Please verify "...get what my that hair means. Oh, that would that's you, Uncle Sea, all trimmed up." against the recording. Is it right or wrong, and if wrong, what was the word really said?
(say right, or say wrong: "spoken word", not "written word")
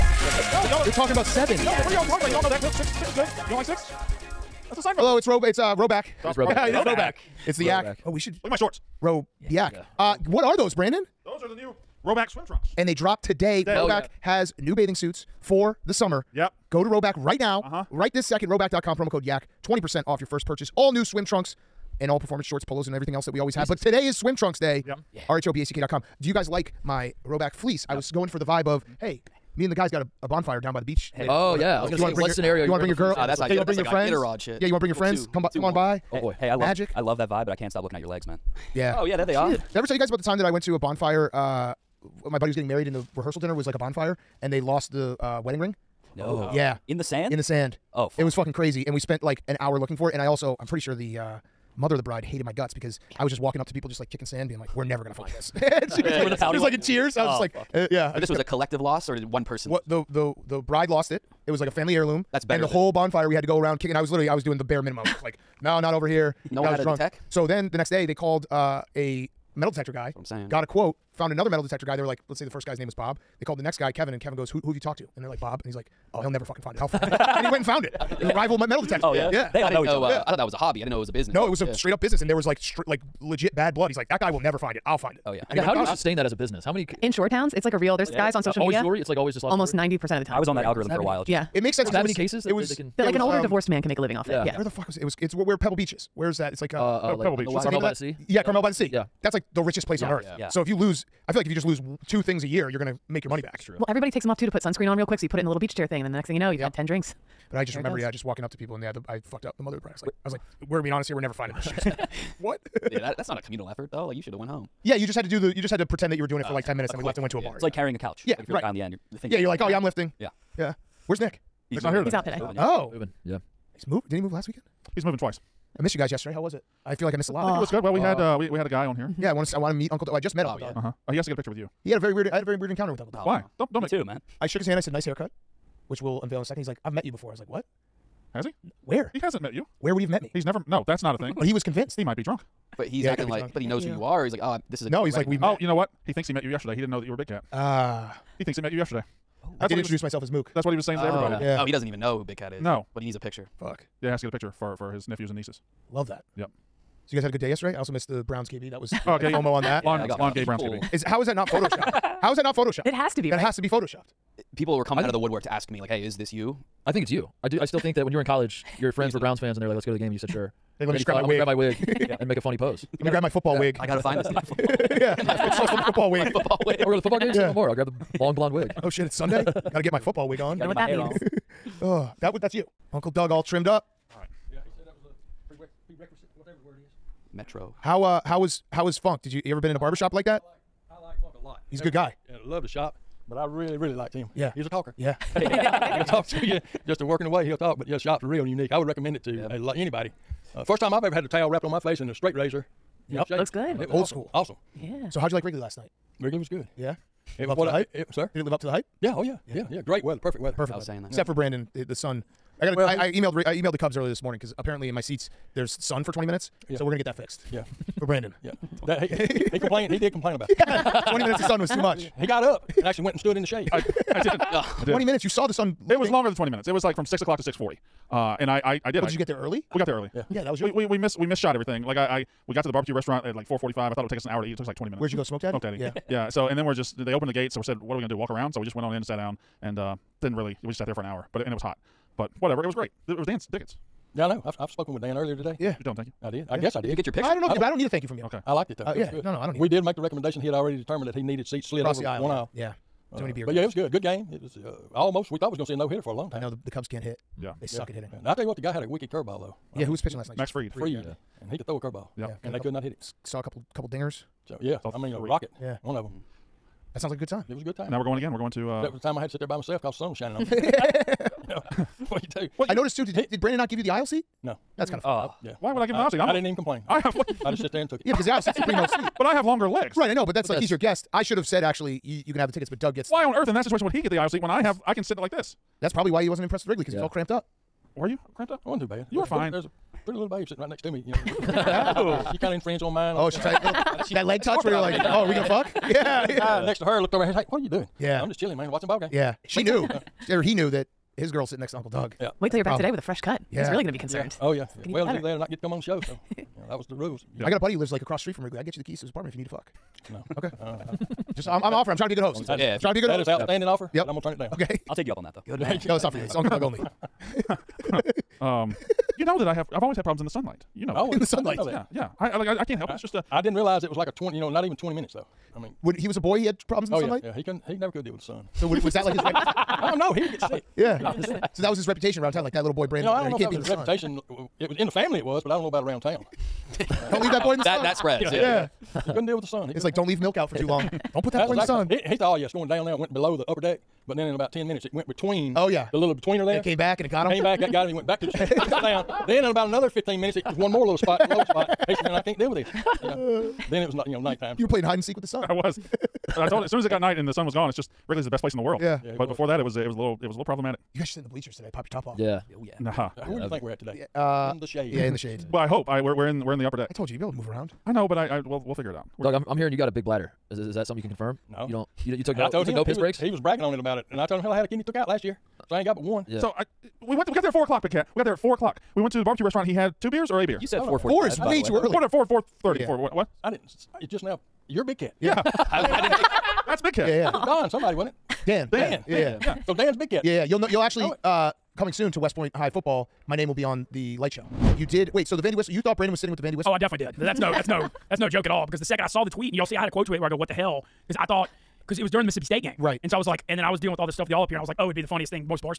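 wrong: "Doug", not "Sea".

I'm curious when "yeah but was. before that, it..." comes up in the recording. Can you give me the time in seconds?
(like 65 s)
359 s.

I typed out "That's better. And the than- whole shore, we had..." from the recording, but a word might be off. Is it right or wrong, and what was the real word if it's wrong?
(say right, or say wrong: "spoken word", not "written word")
wrong: "bonfire", not "shore".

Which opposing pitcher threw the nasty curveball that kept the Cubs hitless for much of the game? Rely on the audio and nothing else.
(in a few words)
Max Fried.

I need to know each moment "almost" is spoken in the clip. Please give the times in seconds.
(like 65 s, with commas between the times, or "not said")
89 s, 254 s.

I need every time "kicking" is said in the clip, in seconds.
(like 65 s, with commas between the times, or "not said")
54 s, 63 s.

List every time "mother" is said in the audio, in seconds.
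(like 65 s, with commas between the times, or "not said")
51 s, 109 s.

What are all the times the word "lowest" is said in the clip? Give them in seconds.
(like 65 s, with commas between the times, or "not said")
351 s.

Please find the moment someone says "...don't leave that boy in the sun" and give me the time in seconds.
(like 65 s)
337 s.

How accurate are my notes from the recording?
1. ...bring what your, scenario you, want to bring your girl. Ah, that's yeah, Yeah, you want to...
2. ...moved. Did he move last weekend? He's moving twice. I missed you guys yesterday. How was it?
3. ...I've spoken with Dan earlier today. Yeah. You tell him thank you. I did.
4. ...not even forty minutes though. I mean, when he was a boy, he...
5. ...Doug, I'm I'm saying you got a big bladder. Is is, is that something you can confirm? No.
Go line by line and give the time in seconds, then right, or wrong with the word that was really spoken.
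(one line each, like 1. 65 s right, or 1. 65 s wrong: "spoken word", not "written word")
1. 32 s right
2. 123 s right
3. 244 s right
4. 324 s wrong: "twenty", not "forty"
5. 369 s wrong: "hearing", not "saying".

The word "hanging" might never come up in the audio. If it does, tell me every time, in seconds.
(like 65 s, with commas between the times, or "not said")
not said.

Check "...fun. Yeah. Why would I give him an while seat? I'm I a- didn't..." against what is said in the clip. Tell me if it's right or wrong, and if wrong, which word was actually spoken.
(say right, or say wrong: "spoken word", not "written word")
wrong: "aisle", not "while".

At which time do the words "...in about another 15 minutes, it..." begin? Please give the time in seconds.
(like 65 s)
349 s.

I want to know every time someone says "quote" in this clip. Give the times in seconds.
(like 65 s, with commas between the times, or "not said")
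70 s, 399 s.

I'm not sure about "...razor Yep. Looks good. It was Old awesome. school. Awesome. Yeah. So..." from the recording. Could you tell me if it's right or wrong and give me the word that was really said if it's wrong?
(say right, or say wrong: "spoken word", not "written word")
right.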